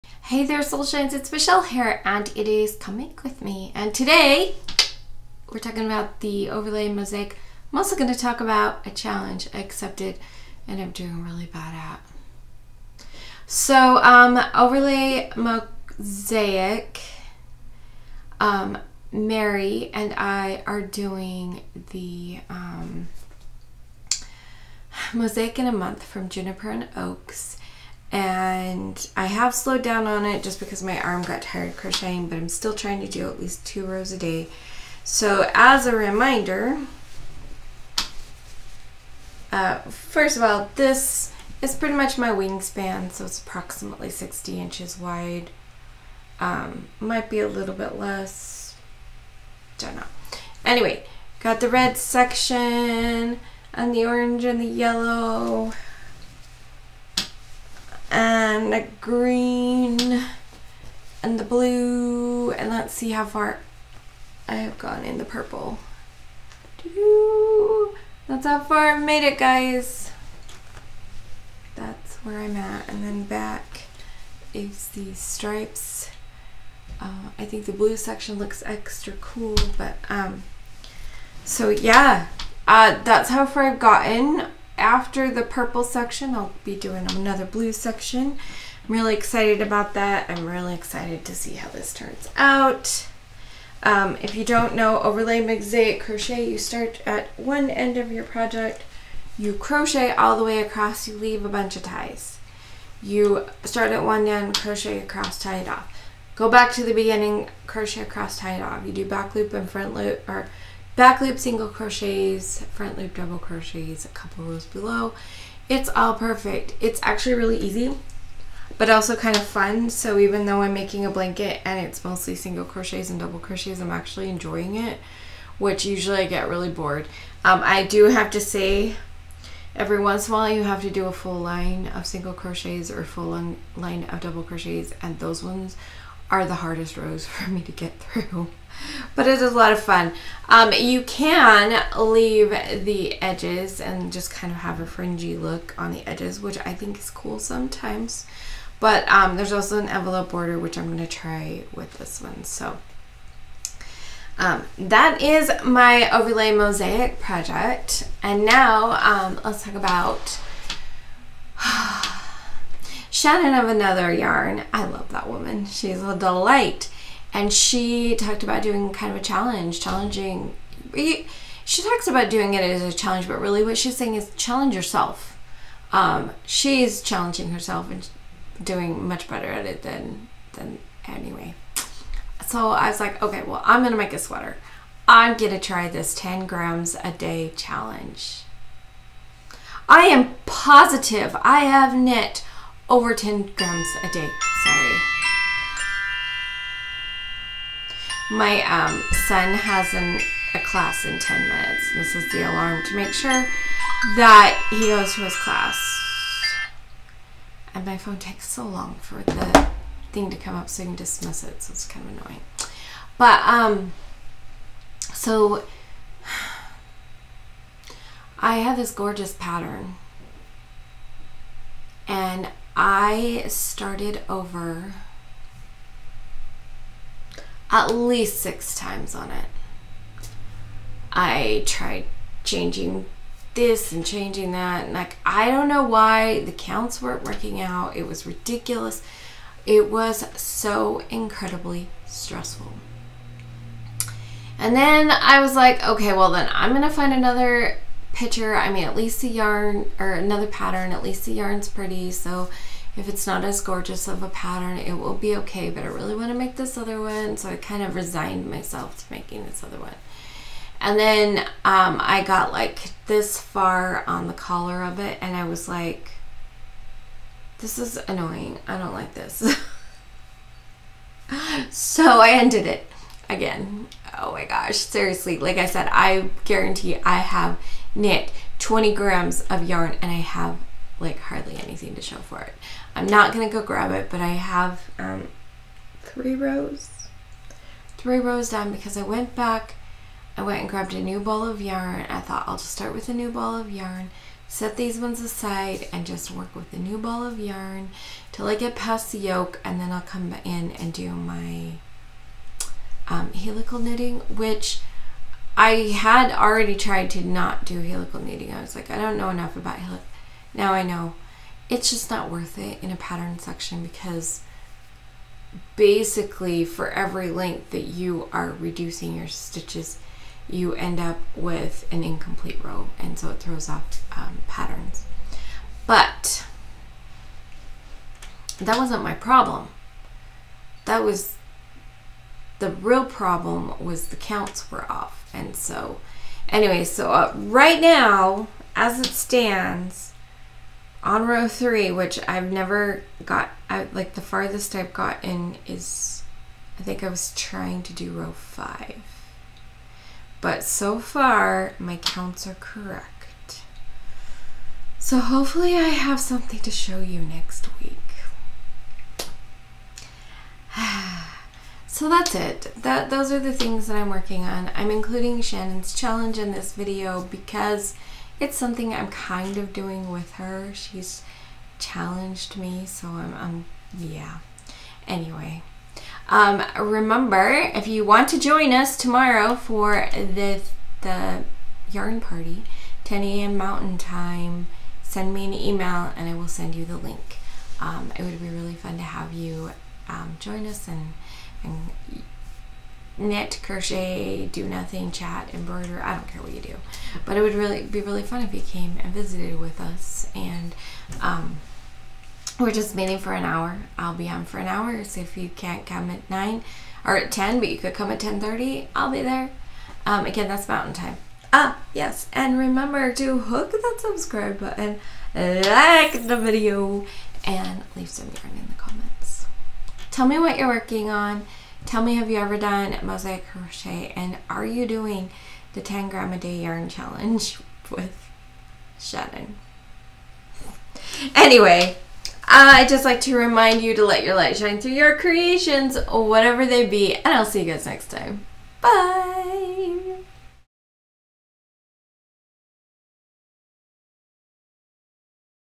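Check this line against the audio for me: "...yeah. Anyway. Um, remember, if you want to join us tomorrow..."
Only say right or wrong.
right.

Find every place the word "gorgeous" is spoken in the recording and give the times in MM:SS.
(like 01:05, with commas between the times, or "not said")
03:38, 04:13.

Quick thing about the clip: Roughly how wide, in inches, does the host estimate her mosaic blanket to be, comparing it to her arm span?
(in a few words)
60 inches.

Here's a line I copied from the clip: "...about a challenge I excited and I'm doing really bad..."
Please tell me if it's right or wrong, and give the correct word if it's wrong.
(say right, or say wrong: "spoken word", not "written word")
wrong: "accepted", not "excited".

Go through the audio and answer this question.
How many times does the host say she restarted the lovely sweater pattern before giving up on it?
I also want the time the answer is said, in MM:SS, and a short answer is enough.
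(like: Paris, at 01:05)
6, at 03:48.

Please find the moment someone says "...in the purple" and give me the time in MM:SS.
01:05.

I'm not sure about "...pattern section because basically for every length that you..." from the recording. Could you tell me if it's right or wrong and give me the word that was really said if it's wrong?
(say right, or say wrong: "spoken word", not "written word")
right.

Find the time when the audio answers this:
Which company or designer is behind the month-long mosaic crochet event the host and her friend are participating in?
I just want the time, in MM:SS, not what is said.
00:26.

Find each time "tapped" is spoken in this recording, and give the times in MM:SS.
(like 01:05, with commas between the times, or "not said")
not said.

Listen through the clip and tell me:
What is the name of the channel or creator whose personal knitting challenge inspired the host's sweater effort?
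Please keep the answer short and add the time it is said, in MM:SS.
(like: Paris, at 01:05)
Another Yarn, at 02:43.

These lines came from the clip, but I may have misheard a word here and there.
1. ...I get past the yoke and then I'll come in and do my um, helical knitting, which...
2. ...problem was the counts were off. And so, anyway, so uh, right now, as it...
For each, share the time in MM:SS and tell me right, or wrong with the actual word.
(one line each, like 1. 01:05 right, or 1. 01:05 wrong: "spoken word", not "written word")
1. 04:58 right
2. 05:33 right.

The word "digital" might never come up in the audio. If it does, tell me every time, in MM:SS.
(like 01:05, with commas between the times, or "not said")
not said.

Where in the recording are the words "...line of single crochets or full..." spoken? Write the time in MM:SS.
02:11.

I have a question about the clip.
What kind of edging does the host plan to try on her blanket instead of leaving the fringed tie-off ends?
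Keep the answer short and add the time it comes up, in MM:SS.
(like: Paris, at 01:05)
envelope border, at 02:29.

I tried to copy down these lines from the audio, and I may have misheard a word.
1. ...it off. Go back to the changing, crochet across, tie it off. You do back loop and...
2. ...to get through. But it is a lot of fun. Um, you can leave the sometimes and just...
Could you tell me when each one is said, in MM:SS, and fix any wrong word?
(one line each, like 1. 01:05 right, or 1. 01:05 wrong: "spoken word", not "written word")
1. 01:45 wrong: "beginning", not "changing"
2. 02:17 wrong: "edges", not "sometimes".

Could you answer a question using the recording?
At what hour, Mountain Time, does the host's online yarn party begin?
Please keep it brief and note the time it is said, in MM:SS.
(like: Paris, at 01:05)
10 a.m., at 06:23.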